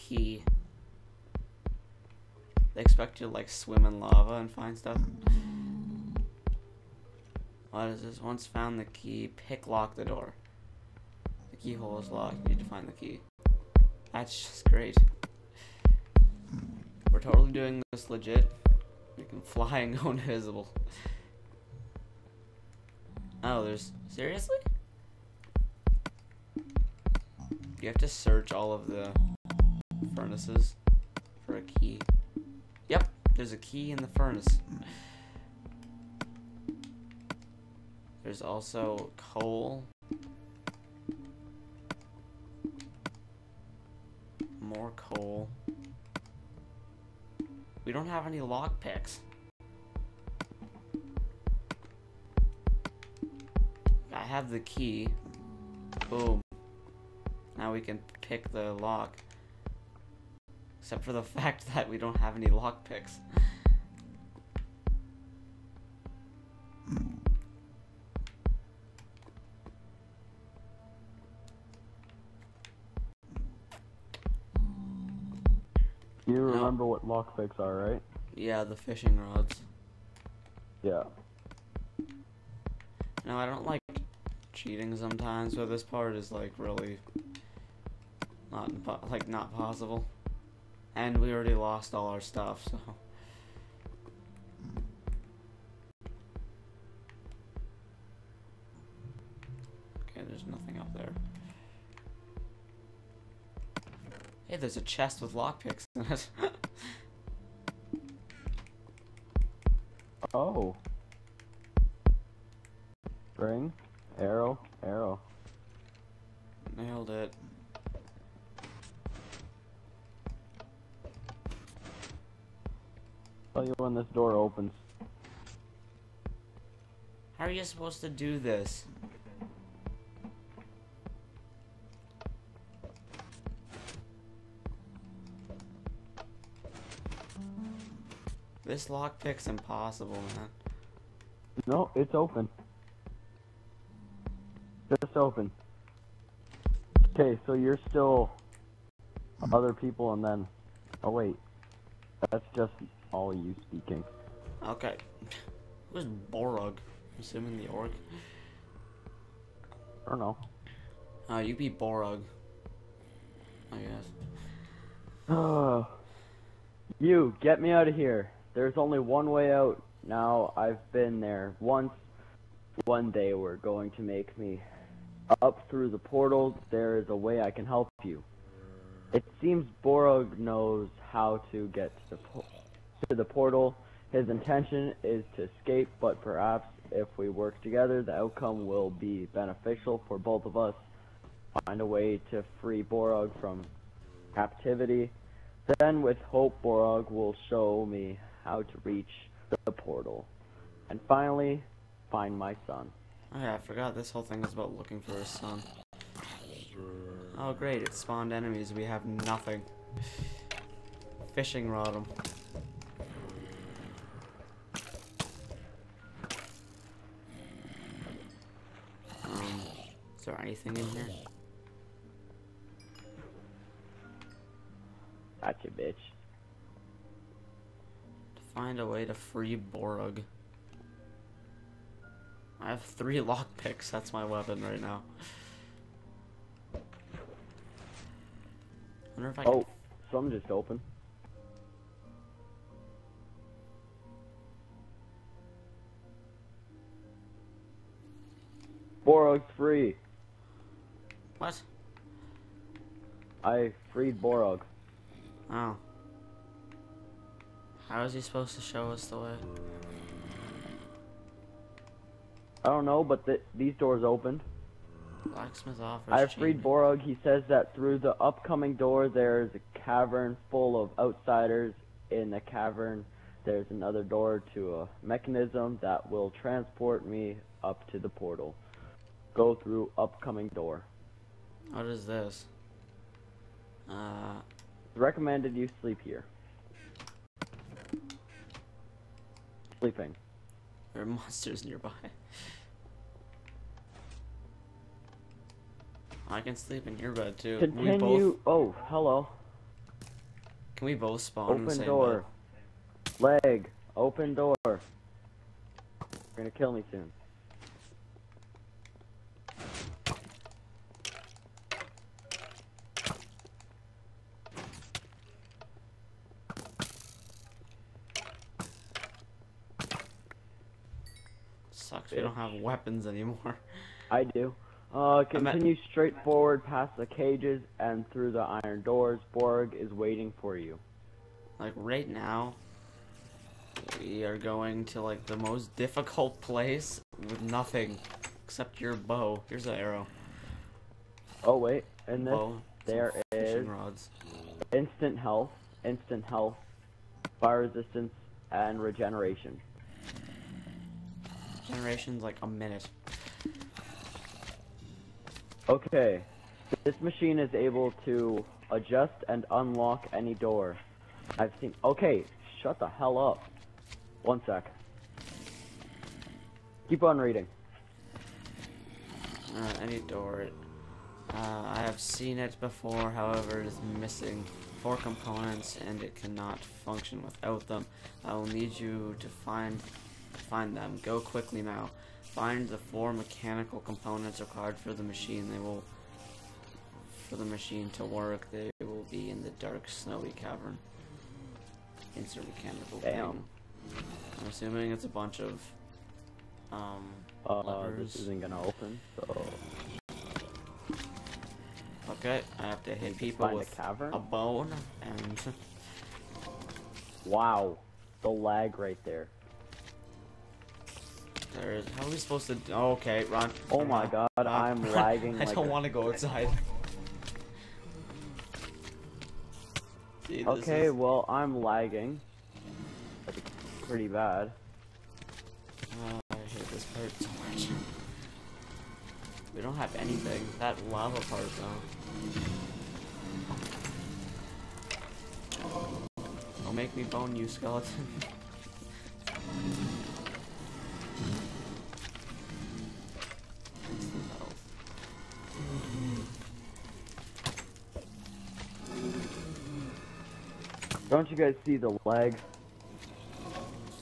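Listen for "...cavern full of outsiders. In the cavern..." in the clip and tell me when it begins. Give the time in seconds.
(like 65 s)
269 s.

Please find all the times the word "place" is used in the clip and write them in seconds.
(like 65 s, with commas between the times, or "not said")
336 s.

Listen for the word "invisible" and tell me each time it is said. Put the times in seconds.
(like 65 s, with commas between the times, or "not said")
20 s.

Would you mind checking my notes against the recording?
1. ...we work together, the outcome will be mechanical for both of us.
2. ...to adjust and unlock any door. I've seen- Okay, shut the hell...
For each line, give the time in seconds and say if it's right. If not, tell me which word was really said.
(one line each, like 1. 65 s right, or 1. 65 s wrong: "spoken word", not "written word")
1. 187 s wrong: "beneficial", not "mechanical"
2. 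358 s right.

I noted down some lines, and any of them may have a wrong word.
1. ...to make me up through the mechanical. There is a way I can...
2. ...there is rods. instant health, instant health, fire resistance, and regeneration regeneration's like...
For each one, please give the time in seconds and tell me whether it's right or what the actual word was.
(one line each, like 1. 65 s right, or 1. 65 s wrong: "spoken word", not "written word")
1. 173 s wrong: "portal", not "mechanical"
2. 342 s wrong: "generation", not "regeneration".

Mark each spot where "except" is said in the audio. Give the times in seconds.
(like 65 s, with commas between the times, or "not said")
60 s, 338 s.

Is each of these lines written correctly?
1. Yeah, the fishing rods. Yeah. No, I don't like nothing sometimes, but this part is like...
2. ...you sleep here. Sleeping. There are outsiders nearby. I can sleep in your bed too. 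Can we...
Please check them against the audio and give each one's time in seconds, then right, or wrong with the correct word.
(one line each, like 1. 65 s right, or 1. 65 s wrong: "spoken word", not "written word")
1. 78 s wrong: "cheating", not "nothing"
2. 285 s wrong: "monsters", not "outsiders".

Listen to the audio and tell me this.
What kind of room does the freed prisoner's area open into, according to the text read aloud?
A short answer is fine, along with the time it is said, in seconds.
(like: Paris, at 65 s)
Blacksmith office, at 265 s.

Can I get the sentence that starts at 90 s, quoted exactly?
And we already lost all our stuff, so.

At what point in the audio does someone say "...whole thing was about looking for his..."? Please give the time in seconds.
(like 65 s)
204 s.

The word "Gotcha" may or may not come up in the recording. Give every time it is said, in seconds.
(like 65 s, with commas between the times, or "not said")
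225 s.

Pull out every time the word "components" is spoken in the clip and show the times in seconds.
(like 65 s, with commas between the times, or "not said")
374 s, 383 s.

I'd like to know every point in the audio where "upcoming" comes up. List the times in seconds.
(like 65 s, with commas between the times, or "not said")
268 s, 279 s.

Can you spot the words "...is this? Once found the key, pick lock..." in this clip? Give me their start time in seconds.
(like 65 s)
7 s.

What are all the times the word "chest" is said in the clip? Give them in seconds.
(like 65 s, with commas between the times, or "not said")
104 s.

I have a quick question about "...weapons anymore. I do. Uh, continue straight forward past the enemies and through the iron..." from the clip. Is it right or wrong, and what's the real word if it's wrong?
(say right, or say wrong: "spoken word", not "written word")
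wrong: "cages", not "enemies".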